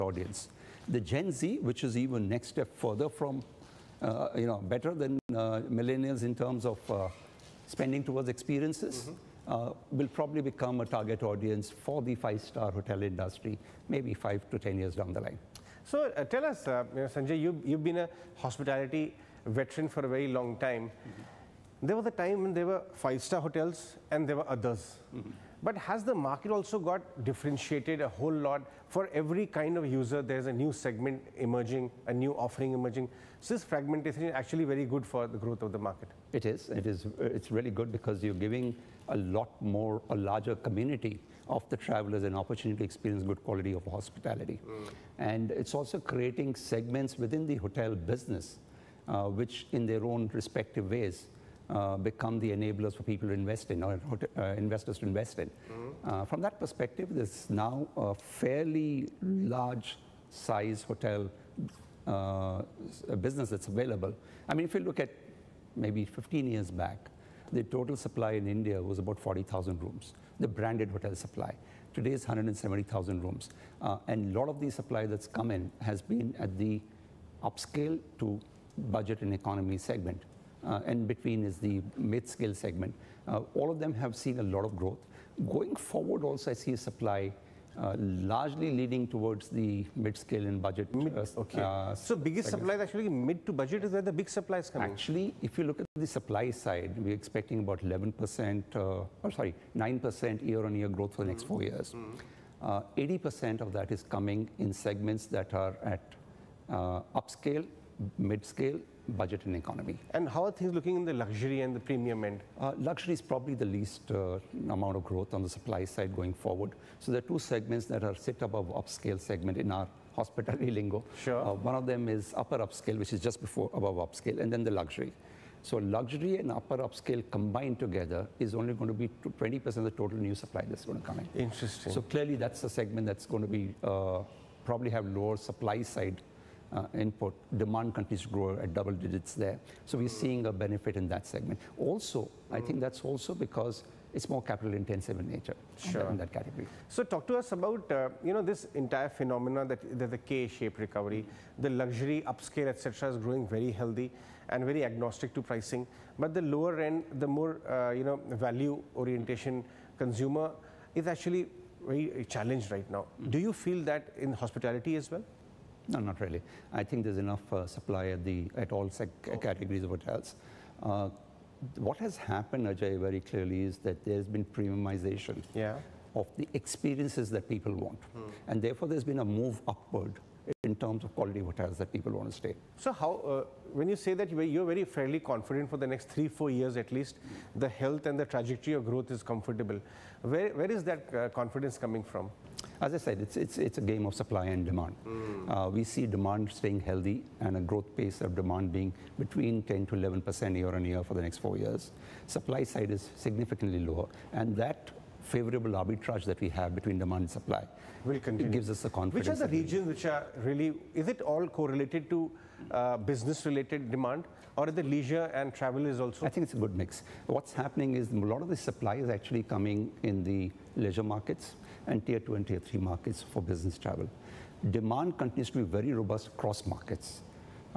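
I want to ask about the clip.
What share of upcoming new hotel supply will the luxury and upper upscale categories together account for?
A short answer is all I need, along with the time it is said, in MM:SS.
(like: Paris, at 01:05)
20%, at 02:09.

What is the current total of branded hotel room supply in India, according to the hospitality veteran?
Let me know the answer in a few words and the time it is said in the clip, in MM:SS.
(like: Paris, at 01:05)
170,000, at 01:12.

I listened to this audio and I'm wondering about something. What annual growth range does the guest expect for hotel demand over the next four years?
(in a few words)
10 to 11%.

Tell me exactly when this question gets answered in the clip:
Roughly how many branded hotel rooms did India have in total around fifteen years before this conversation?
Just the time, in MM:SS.
01:09.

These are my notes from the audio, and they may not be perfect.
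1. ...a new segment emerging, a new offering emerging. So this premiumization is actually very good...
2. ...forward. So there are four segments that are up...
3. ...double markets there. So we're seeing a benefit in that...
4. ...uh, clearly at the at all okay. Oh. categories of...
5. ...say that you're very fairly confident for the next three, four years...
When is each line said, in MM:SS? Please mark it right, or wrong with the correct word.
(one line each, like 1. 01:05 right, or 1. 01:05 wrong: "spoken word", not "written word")
1. 00:30 wrong: "fragmentation", not "premiumization"
2. 01:56 wrong: "two", not "four"
3. 02:18 wrong: "digits", not "markets"
4. 02:47 wrong: "supply", not "clearly"
5. 03:03 right.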